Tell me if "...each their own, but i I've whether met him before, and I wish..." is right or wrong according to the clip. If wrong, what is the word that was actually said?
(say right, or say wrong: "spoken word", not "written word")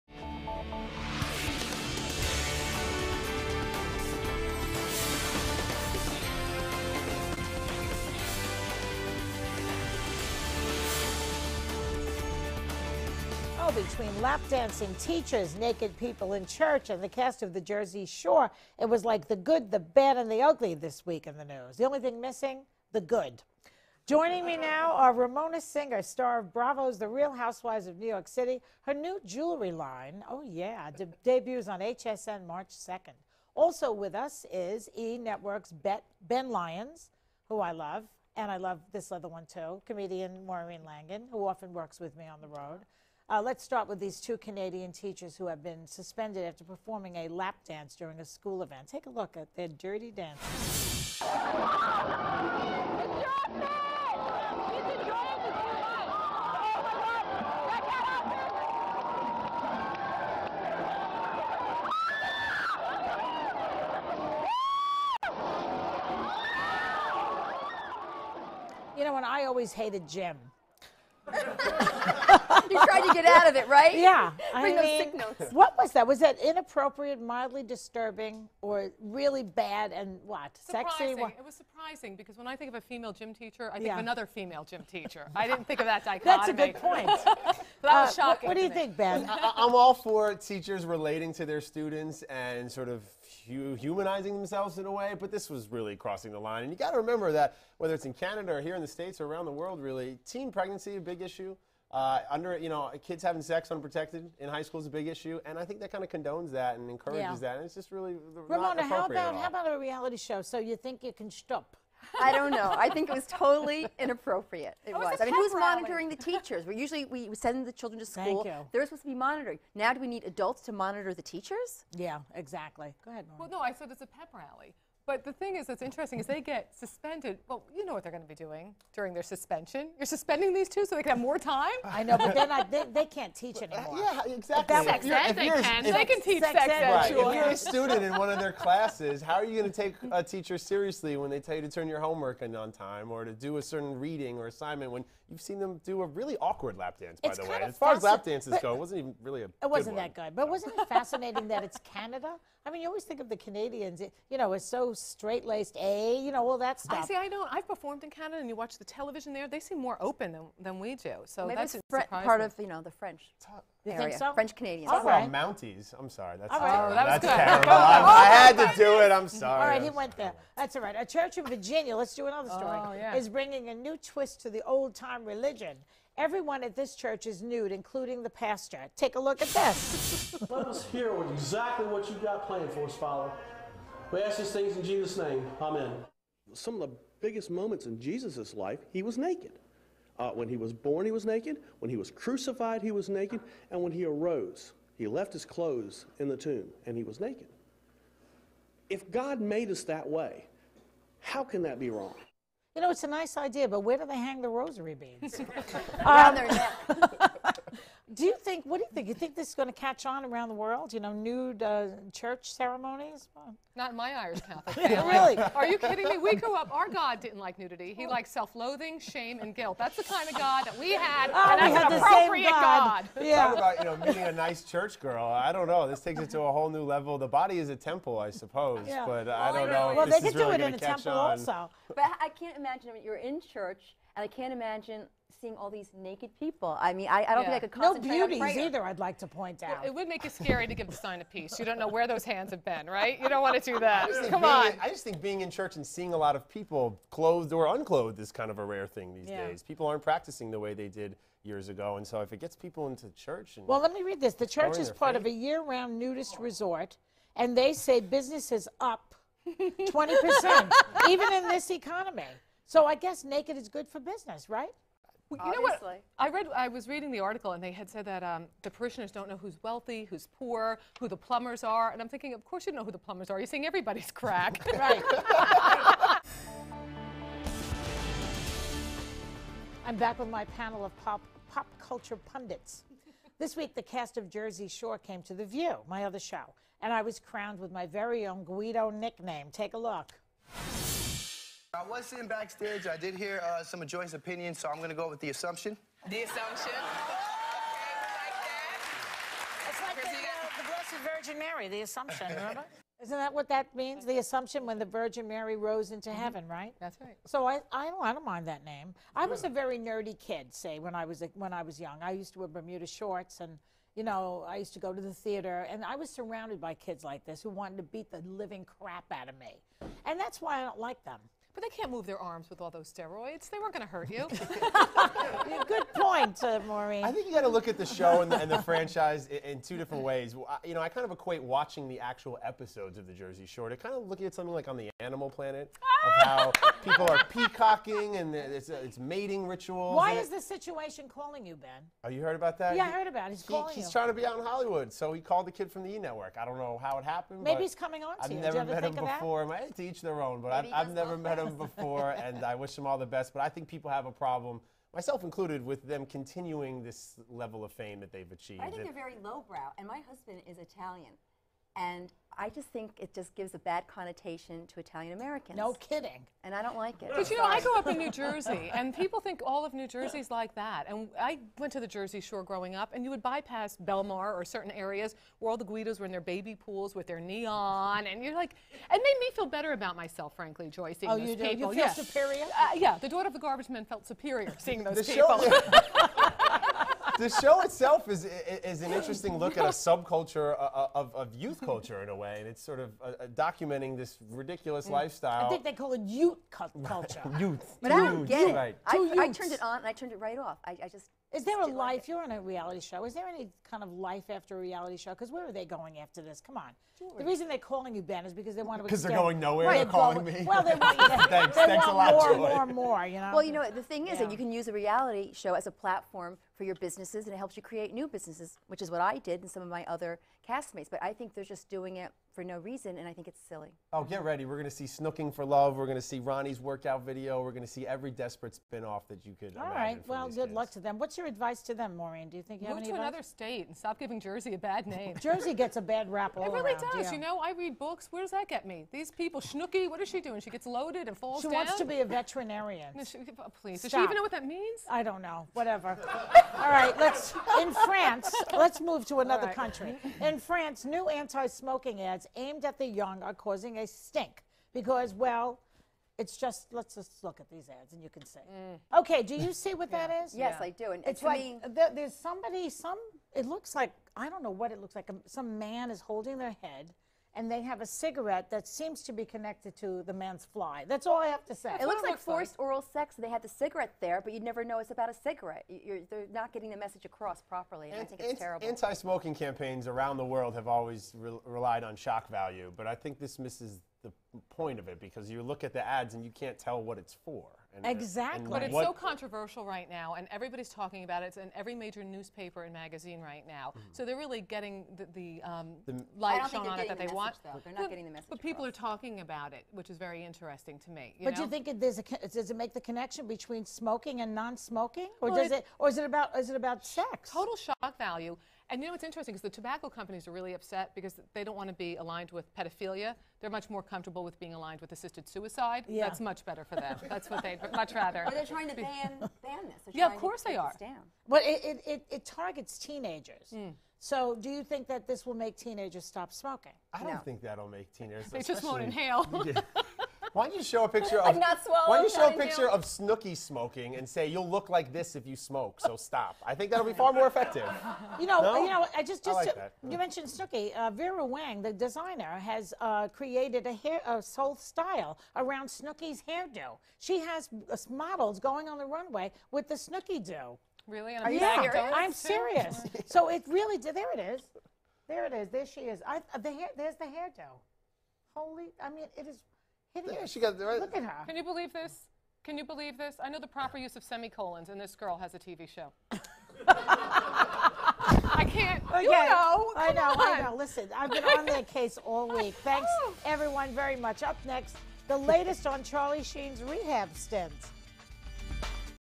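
wrong: "never", not "whether".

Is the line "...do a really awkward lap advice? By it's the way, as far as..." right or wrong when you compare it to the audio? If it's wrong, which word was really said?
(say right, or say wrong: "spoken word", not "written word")
wrong: "dance", not "advice".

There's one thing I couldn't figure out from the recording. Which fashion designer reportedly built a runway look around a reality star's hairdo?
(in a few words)
Vera Wang.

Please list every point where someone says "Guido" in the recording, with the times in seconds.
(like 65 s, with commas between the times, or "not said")
288 s, 375 s.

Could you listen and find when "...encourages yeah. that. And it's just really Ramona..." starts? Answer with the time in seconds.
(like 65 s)
106 s.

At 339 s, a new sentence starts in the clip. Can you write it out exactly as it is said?
Why is this situation calling you, Ben?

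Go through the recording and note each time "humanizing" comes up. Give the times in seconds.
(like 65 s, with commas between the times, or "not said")
93 s.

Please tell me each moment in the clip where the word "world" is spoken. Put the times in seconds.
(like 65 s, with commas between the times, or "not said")
99 s, 210 s, 480 s.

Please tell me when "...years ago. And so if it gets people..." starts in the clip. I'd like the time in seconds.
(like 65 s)
251 s.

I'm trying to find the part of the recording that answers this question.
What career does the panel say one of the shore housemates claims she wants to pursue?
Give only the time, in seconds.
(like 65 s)
442 s.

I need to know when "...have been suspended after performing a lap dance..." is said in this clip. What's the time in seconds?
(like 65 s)
45 s.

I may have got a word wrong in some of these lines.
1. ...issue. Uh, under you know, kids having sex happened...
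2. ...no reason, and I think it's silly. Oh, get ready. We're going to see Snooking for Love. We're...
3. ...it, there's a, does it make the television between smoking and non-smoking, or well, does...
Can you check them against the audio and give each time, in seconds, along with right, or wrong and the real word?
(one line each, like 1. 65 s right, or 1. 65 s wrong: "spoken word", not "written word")
1. 101 s wrong: "unprotected", not "happened"
2. 422 s right
3. 501 s wrong: "connection", not "television".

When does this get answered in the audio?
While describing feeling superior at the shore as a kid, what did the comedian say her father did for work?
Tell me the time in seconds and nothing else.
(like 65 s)
383 s.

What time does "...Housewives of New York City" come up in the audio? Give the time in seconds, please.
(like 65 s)
27 s.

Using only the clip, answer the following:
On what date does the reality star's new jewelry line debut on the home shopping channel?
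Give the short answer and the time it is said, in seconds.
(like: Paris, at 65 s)
March 2nd, at 32 s.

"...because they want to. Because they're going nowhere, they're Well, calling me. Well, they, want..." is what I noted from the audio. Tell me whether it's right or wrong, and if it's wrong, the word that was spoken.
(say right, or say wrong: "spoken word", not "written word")
right.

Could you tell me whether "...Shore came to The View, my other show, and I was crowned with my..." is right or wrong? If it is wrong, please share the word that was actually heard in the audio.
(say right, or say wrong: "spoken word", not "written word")
right.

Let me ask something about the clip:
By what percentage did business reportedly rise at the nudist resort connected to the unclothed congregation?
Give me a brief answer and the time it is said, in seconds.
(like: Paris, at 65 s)
20%, at 259 s.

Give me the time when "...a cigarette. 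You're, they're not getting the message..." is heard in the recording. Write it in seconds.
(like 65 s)
475 s.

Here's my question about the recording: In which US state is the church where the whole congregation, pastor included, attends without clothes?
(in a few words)
Virginia.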